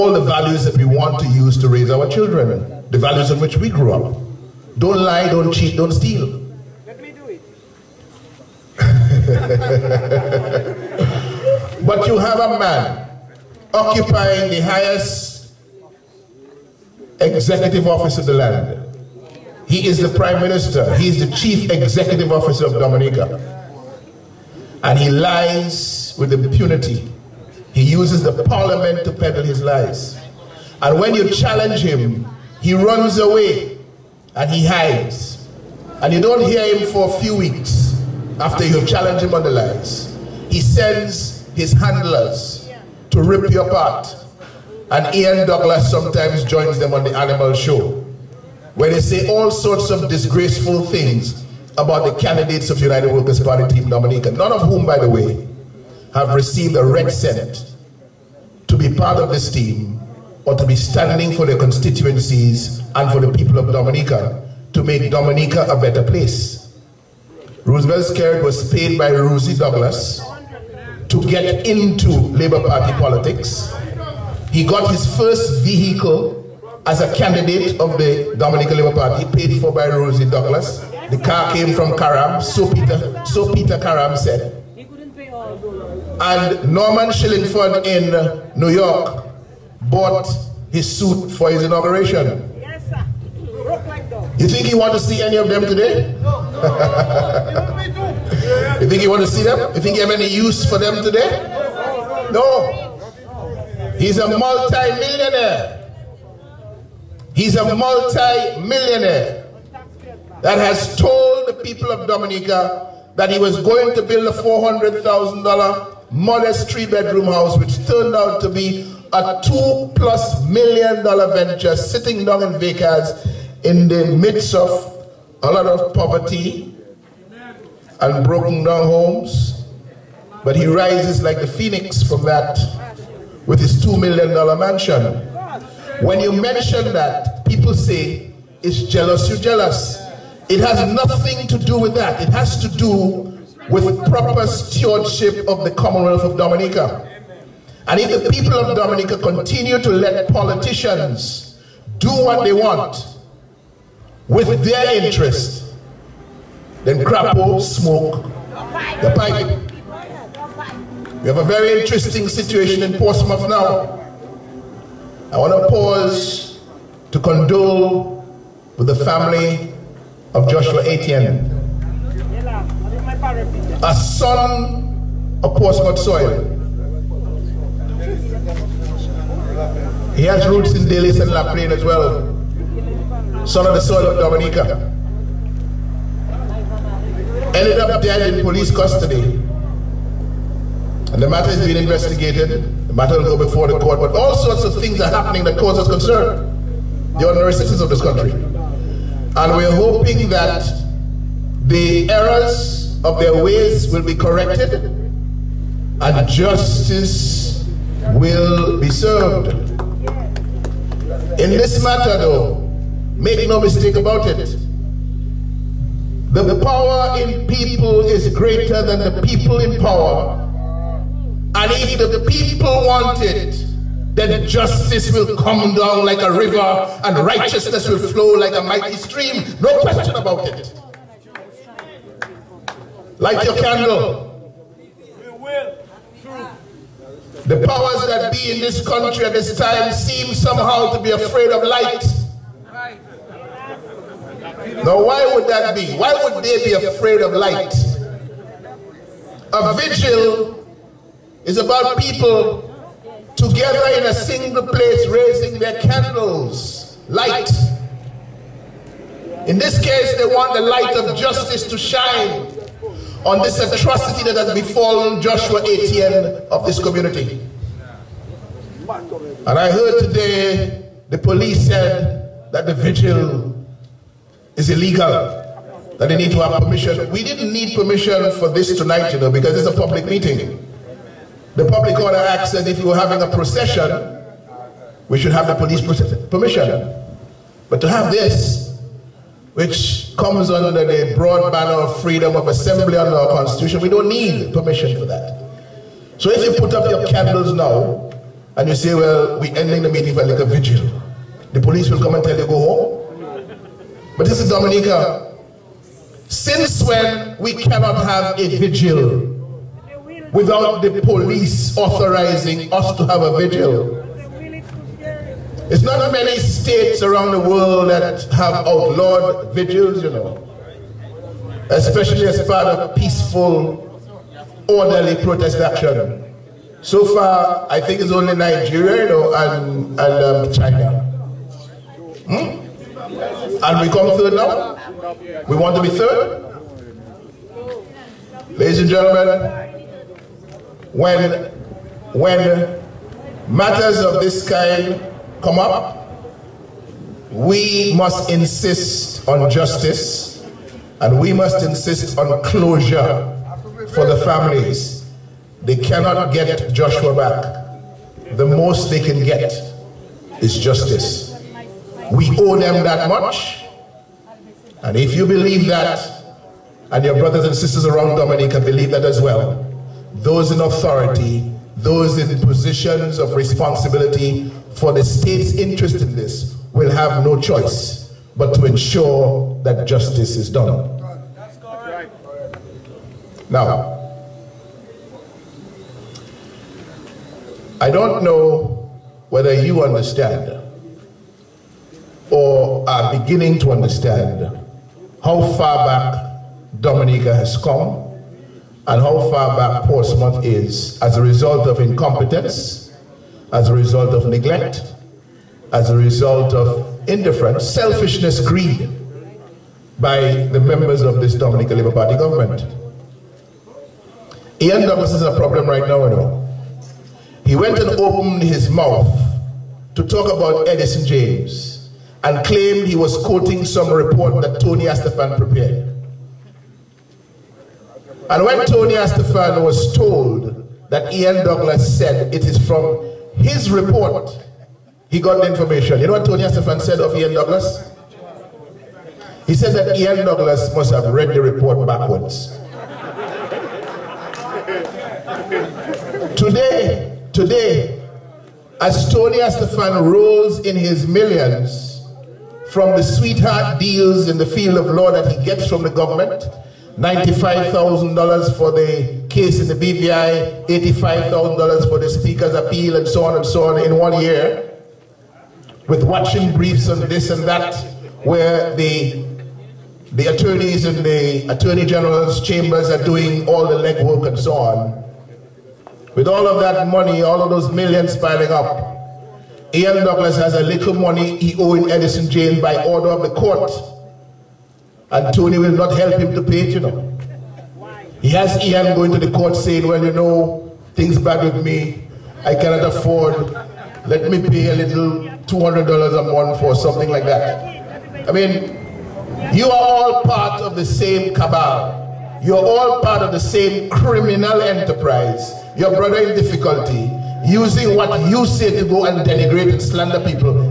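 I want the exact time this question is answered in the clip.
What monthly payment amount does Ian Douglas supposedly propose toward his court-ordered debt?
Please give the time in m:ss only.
8:15.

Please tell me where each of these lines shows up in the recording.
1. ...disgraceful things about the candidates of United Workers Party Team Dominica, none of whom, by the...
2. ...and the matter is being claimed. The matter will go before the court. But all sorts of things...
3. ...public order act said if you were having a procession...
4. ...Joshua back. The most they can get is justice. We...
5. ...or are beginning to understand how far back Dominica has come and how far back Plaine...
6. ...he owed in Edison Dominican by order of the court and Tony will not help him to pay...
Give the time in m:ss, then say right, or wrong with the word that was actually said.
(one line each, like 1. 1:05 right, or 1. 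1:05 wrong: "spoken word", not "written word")
1. 0:50 right
2. 3:11 wrong: "investigated", not "claimed"
3. 4:41 right
4. 5:56 right
5. 6:32 wrong: "Portsmouth", not "Plaine"
6. 8:01 wrong: "James", not "Dominican".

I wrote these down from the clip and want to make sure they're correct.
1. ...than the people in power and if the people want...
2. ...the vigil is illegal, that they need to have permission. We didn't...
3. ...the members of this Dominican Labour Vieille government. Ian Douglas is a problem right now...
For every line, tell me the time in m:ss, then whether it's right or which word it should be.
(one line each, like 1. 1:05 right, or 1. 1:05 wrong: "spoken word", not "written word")
1. 3:38 right
2. 4:32 right
3. 6:50 wrong: "Party", not "Vieille".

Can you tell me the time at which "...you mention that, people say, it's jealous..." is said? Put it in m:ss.
2:16.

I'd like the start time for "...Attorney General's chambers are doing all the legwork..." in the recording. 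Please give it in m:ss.
7:51.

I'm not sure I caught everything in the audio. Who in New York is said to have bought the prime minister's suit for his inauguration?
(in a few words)
Norman Shillingford.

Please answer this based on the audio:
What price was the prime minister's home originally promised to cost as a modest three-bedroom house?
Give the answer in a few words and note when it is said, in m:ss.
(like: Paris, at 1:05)
$400,000, at 1:54.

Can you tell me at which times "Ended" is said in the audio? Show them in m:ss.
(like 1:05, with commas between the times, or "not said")
3:07.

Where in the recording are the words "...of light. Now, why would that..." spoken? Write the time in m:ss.
4:01.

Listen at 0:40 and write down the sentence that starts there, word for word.
He sends his handlers to rip you apart.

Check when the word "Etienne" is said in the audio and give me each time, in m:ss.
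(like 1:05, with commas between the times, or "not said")
2:50, 4:25.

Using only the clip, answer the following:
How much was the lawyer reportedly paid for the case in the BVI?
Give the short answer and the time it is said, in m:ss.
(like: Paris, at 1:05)
$95,000, at 7:36.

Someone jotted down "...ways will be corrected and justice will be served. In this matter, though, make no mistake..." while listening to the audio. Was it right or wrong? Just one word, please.
right.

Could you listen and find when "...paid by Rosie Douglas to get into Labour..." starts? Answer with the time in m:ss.
1:08.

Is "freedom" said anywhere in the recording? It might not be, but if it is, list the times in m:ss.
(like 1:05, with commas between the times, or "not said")
4:52.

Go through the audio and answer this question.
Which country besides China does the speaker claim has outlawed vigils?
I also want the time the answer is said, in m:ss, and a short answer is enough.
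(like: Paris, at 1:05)
Nigeria, at 5:28.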